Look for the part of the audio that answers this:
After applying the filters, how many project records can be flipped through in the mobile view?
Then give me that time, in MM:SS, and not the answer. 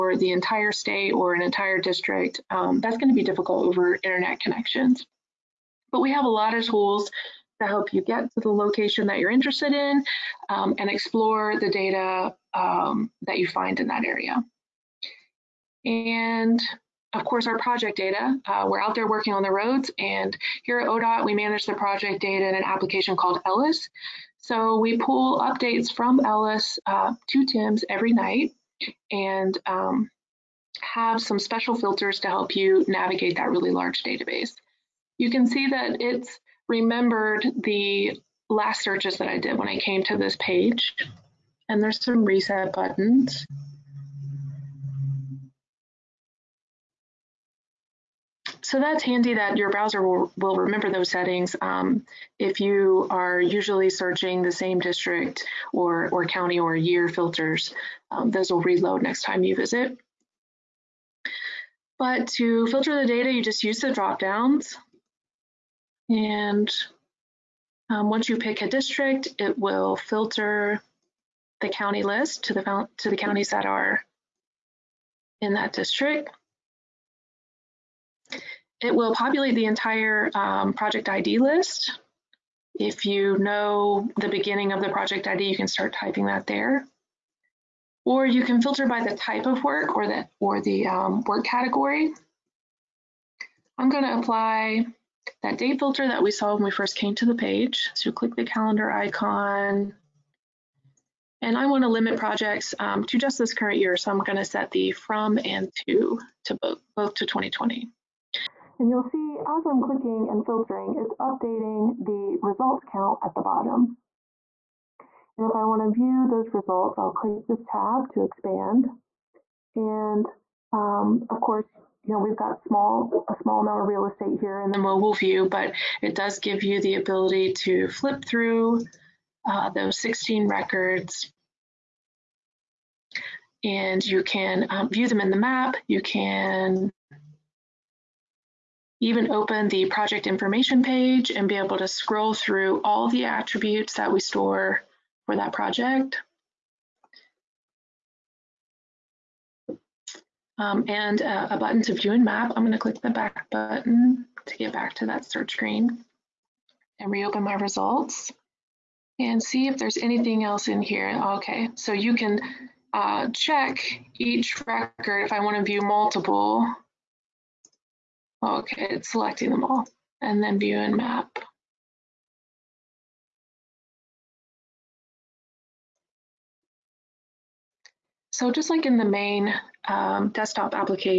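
02:09.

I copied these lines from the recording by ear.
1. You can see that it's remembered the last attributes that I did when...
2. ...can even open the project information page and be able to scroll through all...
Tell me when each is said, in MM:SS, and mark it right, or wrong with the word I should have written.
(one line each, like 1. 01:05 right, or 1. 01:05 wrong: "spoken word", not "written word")
1. 00:35 wrong: "searches", not "attributes"
2. 02:16 right.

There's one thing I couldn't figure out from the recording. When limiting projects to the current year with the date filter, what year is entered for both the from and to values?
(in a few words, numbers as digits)
2020.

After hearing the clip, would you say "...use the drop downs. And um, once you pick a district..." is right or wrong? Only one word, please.
right.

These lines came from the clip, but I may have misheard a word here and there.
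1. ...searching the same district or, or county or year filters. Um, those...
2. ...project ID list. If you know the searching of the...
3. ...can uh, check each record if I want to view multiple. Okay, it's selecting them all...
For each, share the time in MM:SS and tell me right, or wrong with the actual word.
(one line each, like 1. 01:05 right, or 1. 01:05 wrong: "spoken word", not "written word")
1. 00:53 right
2. 01:20 wrong: "beginning", not "searching"
3. 02:42 right.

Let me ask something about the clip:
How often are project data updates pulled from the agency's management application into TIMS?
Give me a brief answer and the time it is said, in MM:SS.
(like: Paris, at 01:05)
Every night, at 00:27.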